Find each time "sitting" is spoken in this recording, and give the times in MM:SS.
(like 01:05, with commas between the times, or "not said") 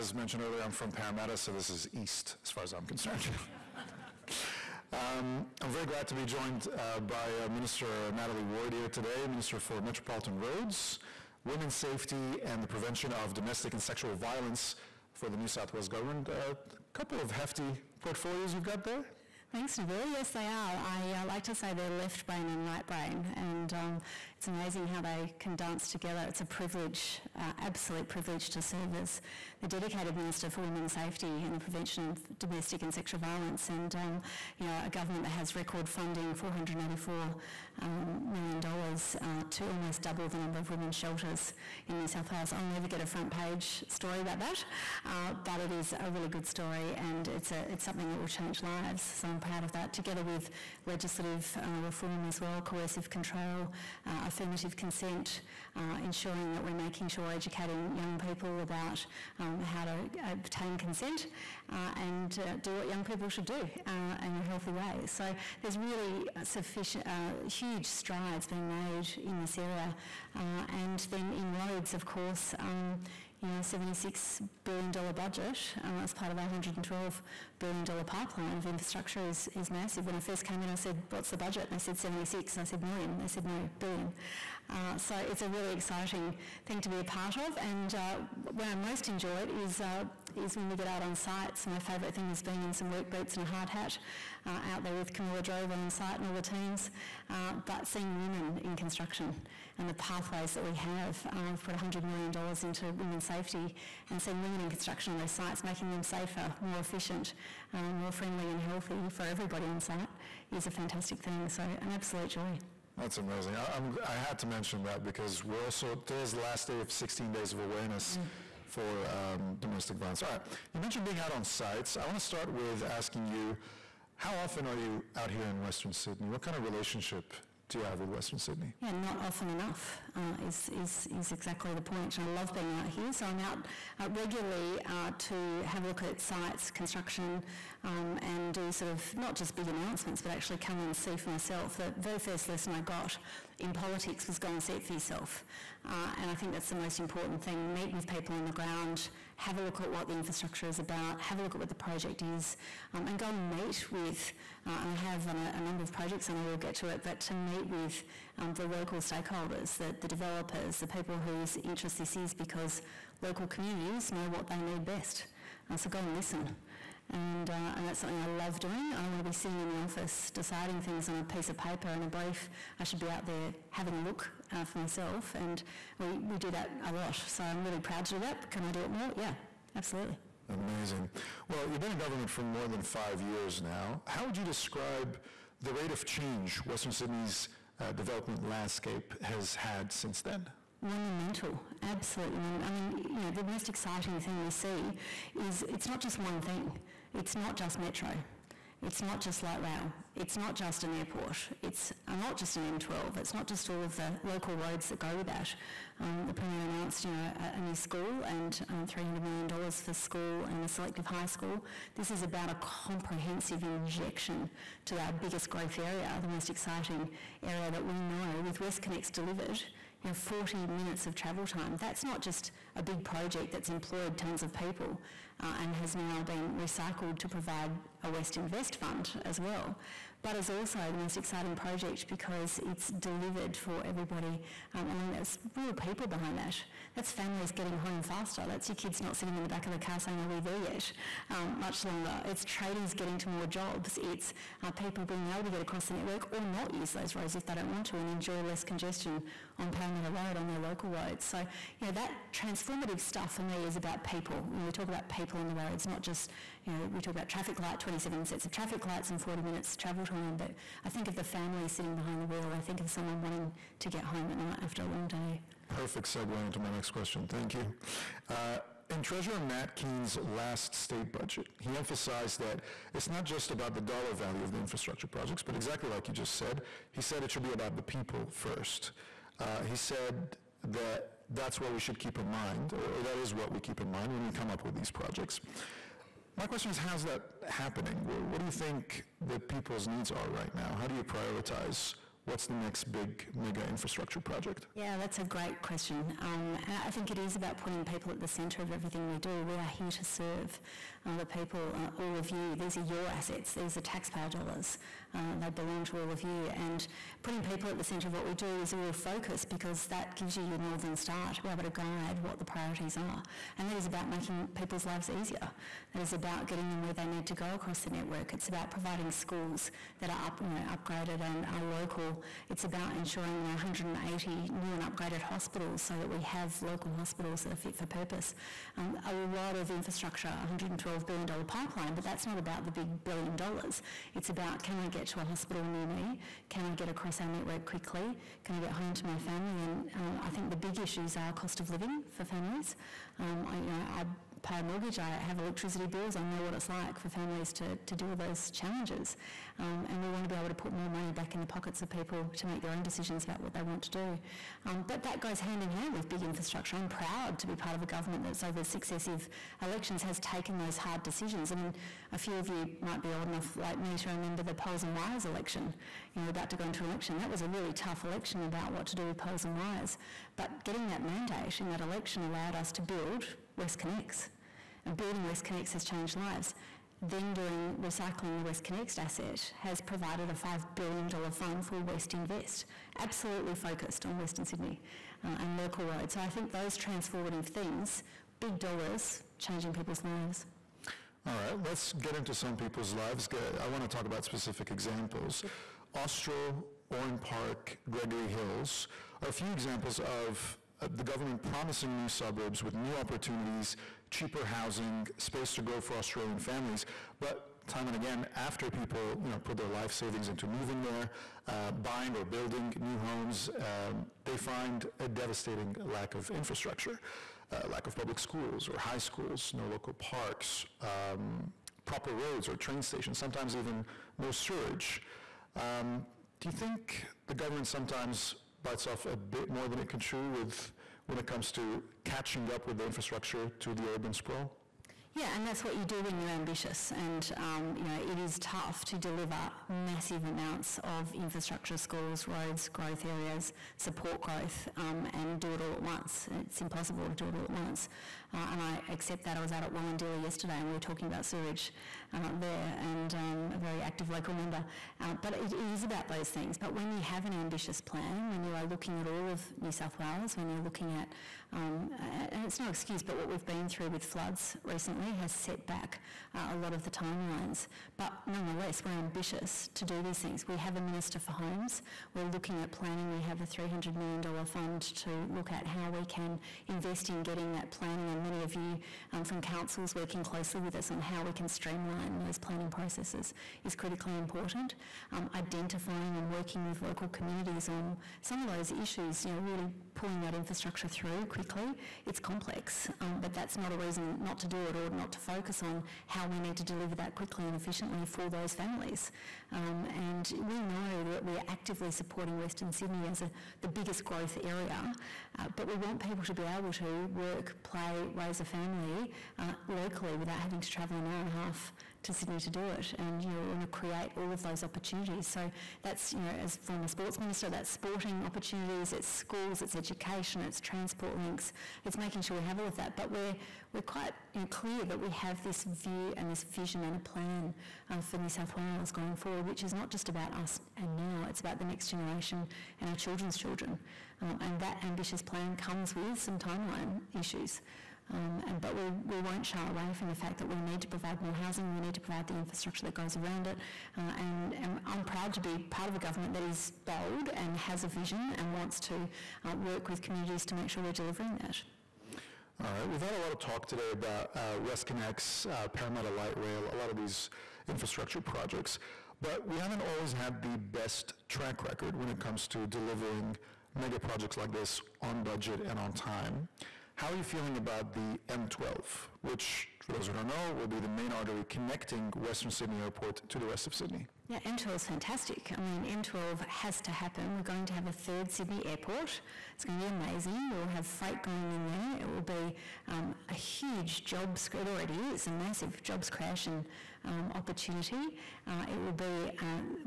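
02:49, 03:59, 04:21.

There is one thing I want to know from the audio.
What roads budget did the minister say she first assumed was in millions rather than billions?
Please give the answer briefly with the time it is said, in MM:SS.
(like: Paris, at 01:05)
$76 billion, at 01:13.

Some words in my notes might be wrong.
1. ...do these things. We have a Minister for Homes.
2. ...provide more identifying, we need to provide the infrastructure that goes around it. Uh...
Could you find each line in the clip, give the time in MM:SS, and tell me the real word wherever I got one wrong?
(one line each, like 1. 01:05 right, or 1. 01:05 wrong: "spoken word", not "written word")
1. 07:49 right
2. 09:00 wrong: "housing", not "identifying".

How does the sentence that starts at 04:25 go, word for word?
Perfect segue into my next question.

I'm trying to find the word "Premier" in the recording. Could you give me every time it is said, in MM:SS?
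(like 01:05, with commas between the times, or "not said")
03:26.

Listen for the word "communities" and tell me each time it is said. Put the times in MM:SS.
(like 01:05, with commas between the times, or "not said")
02:43, 08:07, 09:09.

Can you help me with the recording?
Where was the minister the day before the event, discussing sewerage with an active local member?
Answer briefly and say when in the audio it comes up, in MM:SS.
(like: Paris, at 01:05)
Wollondilly, at 07:29.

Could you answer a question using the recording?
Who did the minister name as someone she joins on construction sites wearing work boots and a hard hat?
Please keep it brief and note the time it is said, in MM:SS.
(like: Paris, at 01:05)
Camilla Drover, at 01:35.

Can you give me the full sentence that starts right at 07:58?
And many of you um, from councils working closely with us on how we can streamline those planning processes is critically important.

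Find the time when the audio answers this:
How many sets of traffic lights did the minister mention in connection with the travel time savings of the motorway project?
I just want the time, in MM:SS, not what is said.
04:17.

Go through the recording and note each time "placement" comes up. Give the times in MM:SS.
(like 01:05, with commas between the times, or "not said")
not said.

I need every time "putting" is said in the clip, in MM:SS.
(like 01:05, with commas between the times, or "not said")
04:57, 05:07.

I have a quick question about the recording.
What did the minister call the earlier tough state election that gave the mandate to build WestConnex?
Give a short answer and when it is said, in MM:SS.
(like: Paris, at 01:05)
Poles and wires election, at 06:04.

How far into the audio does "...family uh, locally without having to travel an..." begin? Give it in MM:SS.
08:28.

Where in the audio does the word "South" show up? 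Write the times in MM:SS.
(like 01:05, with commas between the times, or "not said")
00:15, 00:42, 07:39, 08:48.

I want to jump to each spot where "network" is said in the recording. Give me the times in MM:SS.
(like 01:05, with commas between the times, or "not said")
04:05, 05:17, 05:37.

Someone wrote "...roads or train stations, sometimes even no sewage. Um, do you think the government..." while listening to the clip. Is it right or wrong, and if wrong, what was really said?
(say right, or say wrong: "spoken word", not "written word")
right.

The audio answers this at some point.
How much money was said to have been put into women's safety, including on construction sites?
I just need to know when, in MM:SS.
01:41.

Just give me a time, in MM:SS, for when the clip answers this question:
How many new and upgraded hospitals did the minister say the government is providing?
05:23.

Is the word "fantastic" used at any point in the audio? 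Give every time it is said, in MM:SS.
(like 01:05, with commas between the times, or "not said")
01:50, 09:34.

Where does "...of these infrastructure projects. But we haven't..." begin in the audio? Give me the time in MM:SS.
09:16.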